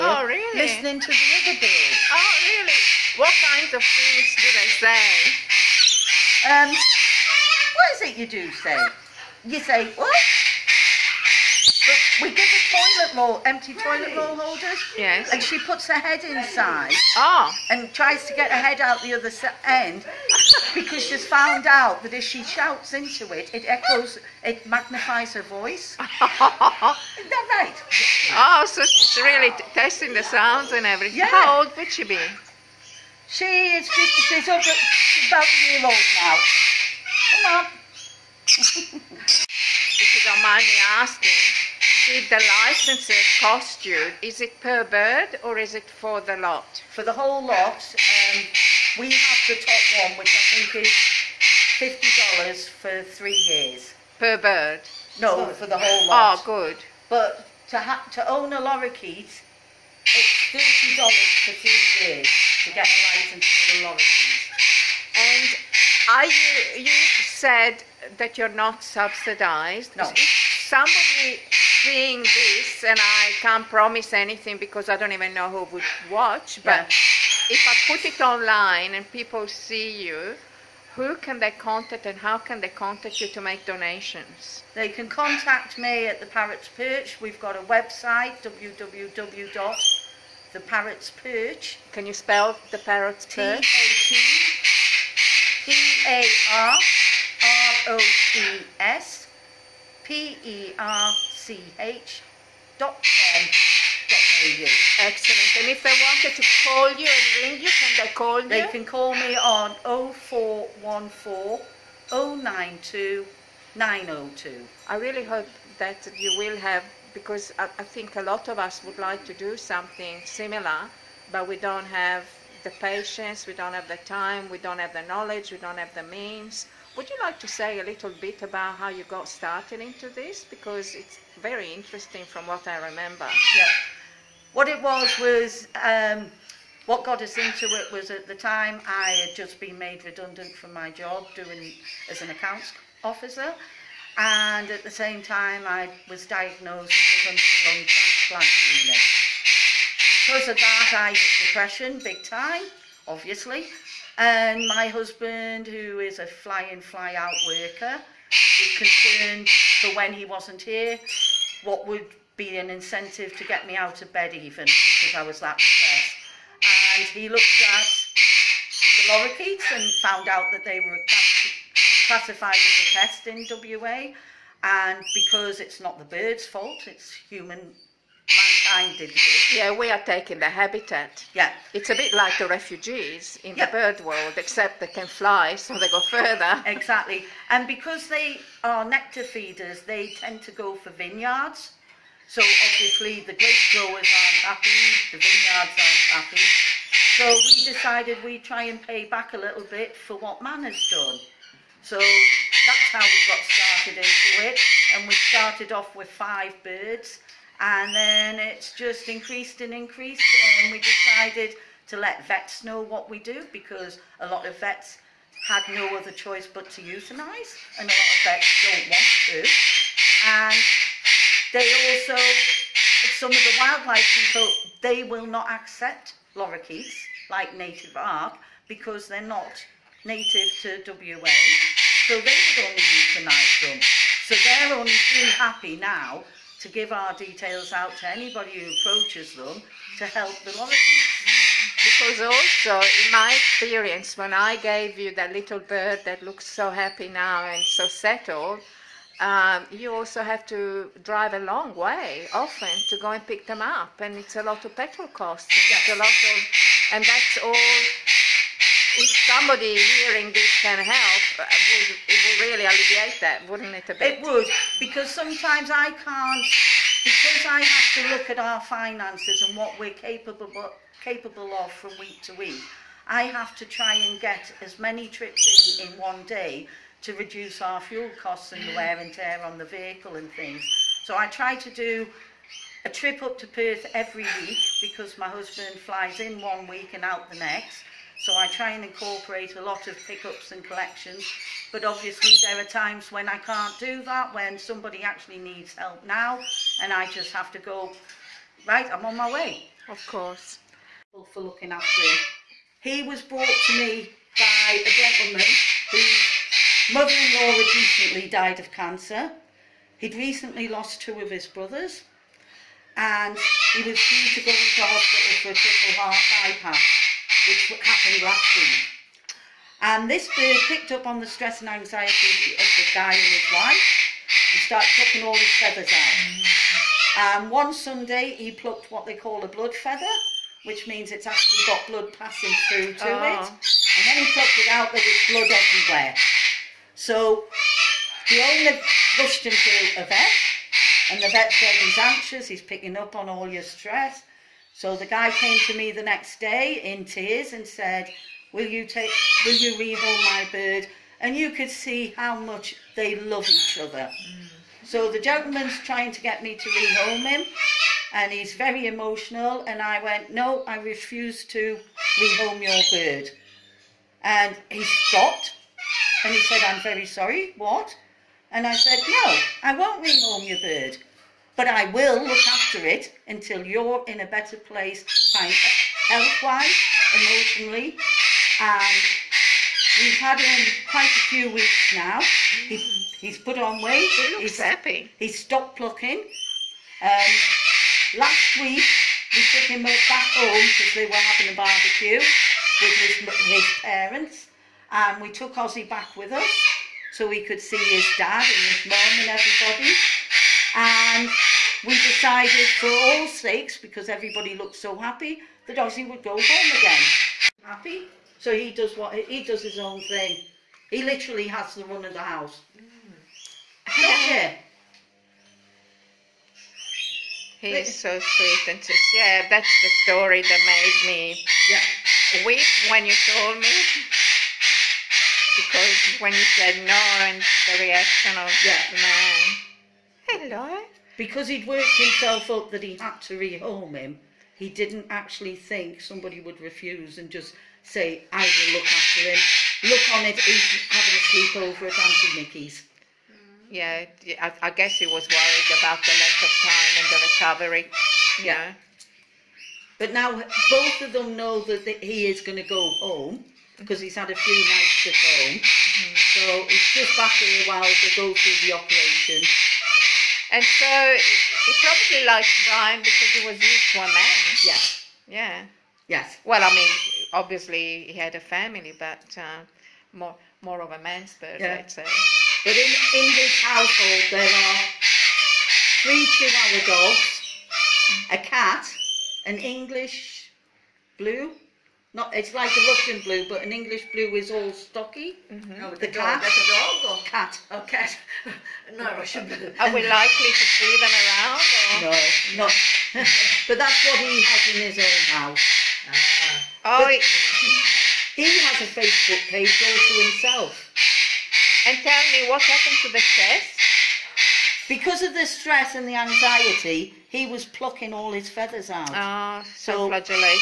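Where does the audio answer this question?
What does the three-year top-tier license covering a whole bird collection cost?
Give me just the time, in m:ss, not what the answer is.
0:51.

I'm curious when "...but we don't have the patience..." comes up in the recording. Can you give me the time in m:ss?
2:01.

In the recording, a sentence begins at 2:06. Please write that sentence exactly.
Would you like to say a little bit about how you got started into this?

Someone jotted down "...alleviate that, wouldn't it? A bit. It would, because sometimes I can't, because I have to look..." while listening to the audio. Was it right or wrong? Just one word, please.
right.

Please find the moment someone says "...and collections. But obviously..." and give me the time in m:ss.
4:50.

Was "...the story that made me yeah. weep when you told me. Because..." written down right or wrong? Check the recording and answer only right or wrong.
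right.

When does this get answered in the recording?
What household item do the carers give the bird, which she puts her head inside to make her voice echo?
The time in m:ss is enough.
0:13.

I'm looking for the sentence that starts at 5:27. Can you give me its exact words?
And one Sunday he plucked what they call a blood feather, which means it's actually got blood passing through to ah.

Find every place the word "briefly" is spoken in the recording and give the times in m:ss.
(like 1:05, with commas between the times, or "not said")
not said.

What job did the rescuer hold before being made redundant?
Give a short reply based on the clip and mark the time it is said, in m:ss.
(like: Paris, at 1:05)
Accounts officer, at 2:22.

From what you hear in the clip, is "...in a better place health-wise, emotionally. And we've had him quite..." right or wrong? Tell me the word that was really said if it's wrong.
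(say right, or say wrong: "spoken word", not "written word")
right.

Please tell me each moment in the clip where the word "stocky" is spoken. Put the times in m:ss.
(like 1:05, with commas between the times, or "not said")
8:04.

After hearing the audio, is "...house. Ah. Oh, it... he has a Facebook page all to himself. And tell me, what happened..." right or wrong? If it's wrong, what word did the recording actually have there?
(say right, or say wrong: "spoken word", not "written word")
right.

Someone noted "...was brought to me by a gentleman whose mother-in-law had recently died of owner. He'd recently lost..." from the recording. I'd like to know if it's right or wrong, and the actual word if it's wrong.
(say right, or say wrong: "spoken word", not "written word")
wrong: "cancer", not "owner".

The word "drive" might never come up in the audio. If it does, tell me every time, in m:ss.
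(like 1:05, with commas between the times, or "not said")
4:11.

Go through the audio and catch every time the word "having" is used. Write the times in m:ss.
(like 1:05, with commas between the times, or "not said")
6:31, 7:20.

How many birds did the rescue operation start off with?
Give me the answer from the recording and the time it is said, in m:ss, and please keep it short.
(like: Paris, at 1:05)
5, at 3:26.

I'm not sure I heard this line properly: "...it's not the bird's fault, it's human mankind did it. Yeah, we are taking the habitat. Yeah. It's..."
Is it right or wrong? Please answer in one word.
right.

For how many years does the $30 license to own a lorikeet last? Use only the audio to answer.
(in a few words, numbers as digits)
2.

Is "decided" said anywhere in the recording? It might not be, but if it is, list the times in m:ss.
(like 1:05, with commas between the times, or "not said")
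3:17, 3:30, 6:41.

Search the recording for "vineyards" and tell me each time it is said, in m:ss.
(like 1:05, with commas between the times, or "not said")
3:10, 3:15.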